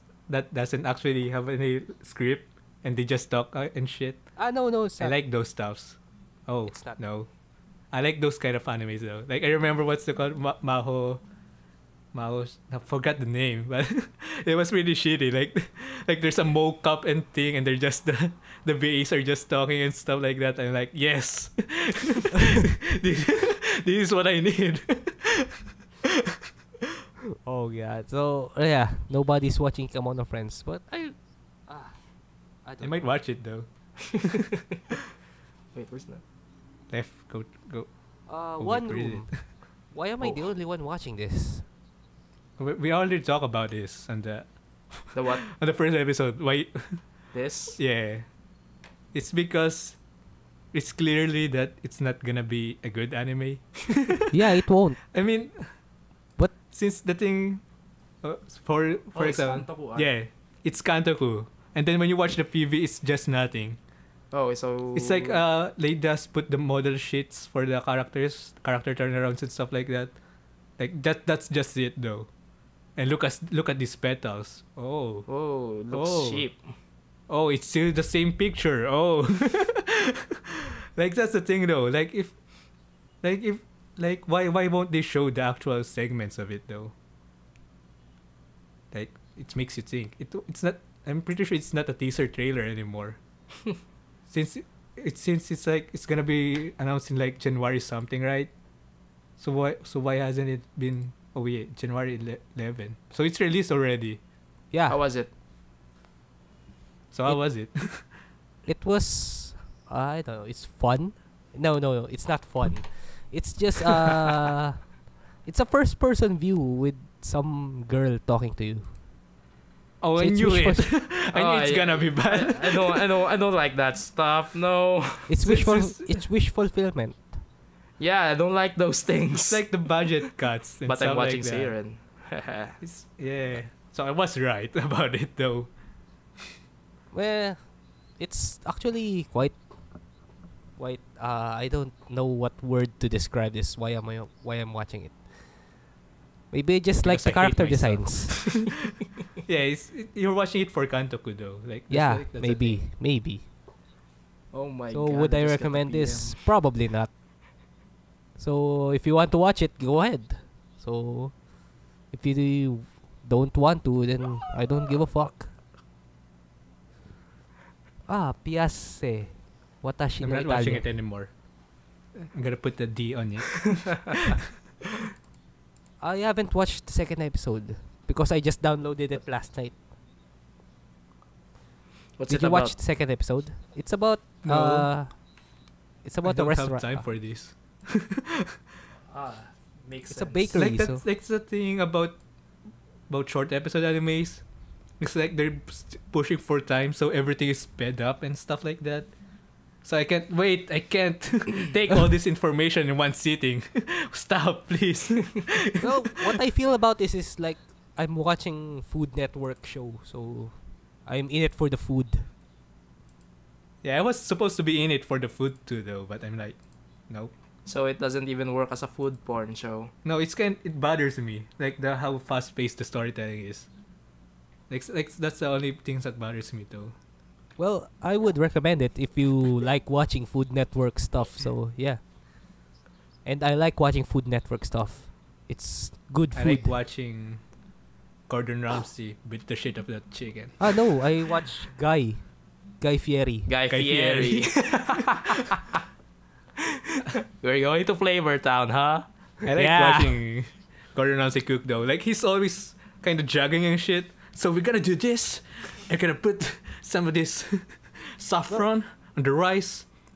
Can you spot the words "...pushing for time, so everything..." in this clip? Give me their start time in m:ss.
3:16.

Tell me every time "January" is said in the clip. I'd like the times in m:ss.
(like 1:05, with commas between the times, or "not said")
1:37, 1:41.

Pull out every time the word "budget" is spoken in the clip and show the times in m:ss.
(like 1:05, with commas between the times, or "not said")
2:09.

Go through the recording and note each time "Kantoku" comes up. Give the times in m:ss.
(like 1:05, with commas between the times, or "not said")
1:00, 2:30.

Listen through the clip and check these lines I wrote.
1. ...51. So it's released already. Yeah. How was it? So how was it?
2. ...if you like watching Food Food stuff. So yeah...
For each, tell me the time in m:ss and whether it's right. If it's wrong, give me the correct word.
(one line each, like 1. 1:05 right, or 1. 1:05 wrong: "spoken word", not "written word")
1. 1:42 wrong: "11", not "51"
2. 3:48 wrong: "Network", not "Food".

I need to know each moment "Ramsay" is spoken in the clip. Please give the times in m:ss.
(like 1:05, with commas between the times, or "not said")
3:58, 4:11.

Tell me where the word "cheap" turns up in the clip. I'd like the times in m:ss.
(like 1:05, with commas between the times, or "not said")
1:16.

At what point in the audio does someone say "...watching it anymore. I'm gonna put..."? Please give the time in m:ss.
2:50.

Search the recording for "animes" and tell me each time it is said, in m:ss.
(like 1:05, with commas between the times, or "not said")
0:08, 0:53, 3:13.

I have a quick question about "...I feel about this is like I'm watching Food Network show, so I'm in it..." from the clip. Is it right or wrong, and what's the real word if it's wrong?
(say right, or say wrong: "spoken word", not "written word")
right.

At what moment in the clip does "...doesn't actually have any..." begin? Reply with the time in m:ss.
0:00.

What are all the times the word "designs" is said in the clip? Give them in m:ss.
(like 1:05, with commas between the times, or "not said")
2:27.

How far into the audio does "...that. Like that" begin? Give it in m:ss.
1:09.